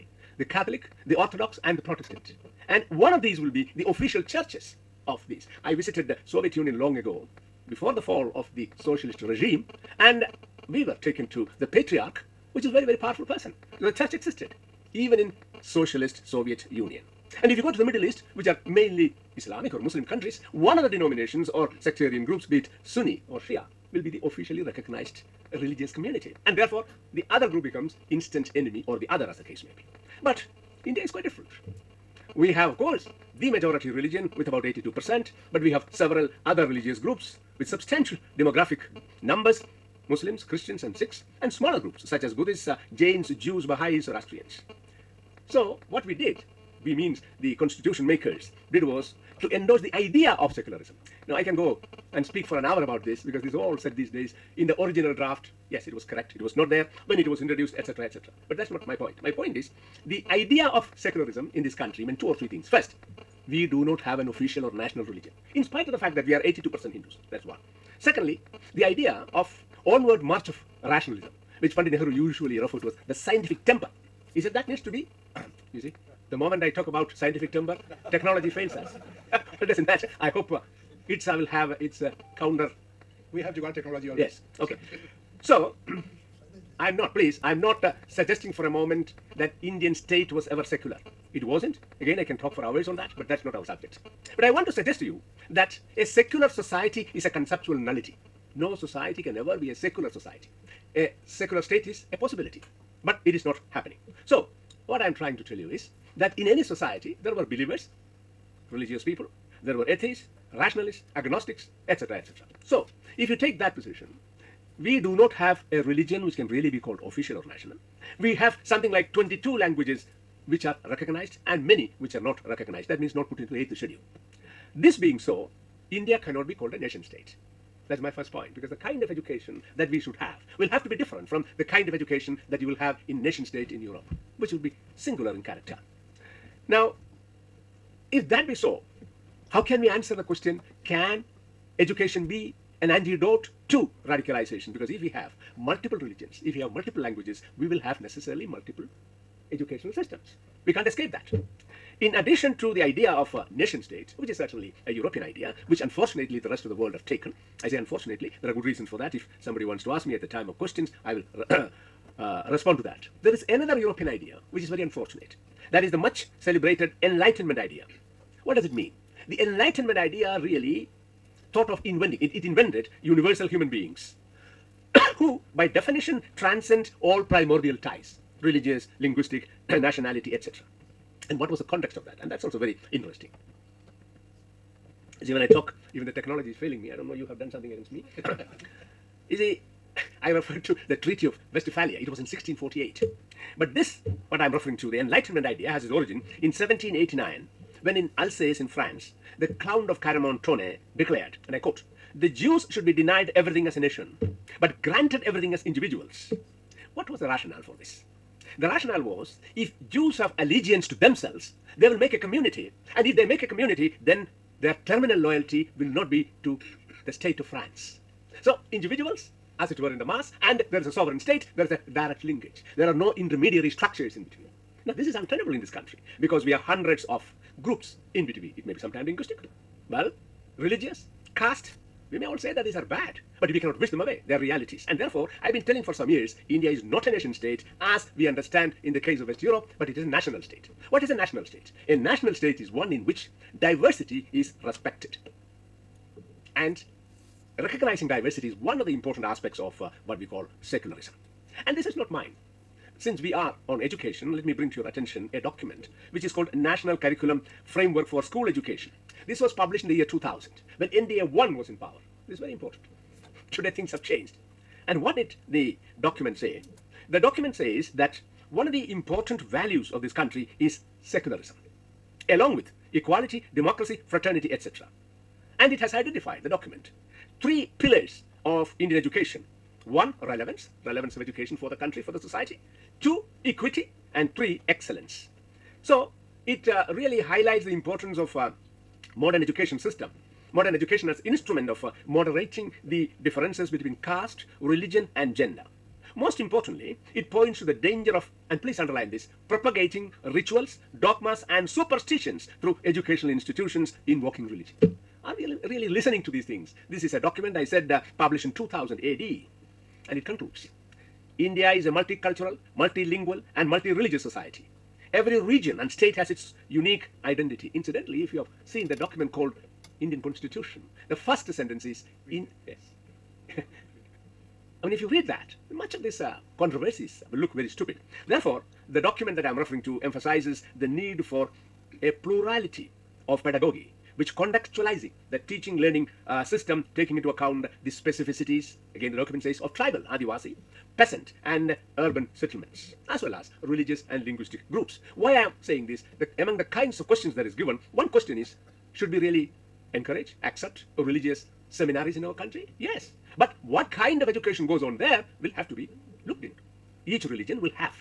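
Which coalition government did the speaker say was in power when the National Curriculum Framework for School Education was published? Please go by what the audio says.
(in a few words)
NDA 1.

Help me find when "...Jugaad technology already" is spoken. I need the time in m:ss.
1:23.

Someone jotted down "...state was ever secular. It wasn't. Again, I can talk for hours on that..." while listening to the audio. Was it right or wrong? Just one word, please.
right.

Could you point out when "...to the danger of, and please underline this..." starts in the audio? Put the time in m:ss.
4:57.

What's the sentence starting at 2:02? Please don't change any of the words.
That means not put into the 8th schedule.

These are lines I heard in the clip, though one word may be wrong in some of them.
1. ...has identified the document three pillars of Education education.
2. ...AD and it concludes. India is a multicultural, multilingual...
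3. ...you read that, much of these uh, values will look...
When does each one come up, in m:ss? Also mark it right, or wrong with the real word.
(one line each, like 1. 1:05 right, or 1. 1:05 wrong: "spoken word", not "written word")
1. 4:35 wrong: "Indian", not "Education"
2. 5:08 right
3. 5:25 wrong: "controversies", not "values".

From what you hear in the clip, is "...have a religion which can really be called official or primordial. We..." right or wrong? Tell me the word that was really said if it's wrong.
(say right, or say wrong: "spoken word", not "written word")
wrong: "national", not "primordial".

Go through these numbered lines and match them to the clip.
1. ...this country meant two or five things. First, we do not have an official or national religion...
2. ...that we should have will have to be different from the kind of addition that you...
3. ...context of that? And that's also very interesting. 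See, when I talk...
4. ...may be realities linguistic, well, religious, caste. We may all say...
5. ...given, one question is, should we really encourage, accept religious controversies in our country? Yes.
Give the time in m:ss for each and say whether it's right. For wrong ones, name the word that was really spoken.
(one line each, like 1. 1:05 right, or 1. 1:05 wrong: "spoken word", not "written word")
1. 1:01 wrong: "three", not "five"
2. 2:09 wrong: "education", not "addition"
3. 3:01 right
4. 3:48 wrong: "sometimes", not "realities"
5. 5:47 wrong: "seminaries", not "controversies".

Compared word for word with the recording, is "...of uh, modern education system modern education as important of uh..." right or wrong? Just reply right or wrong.
wrong.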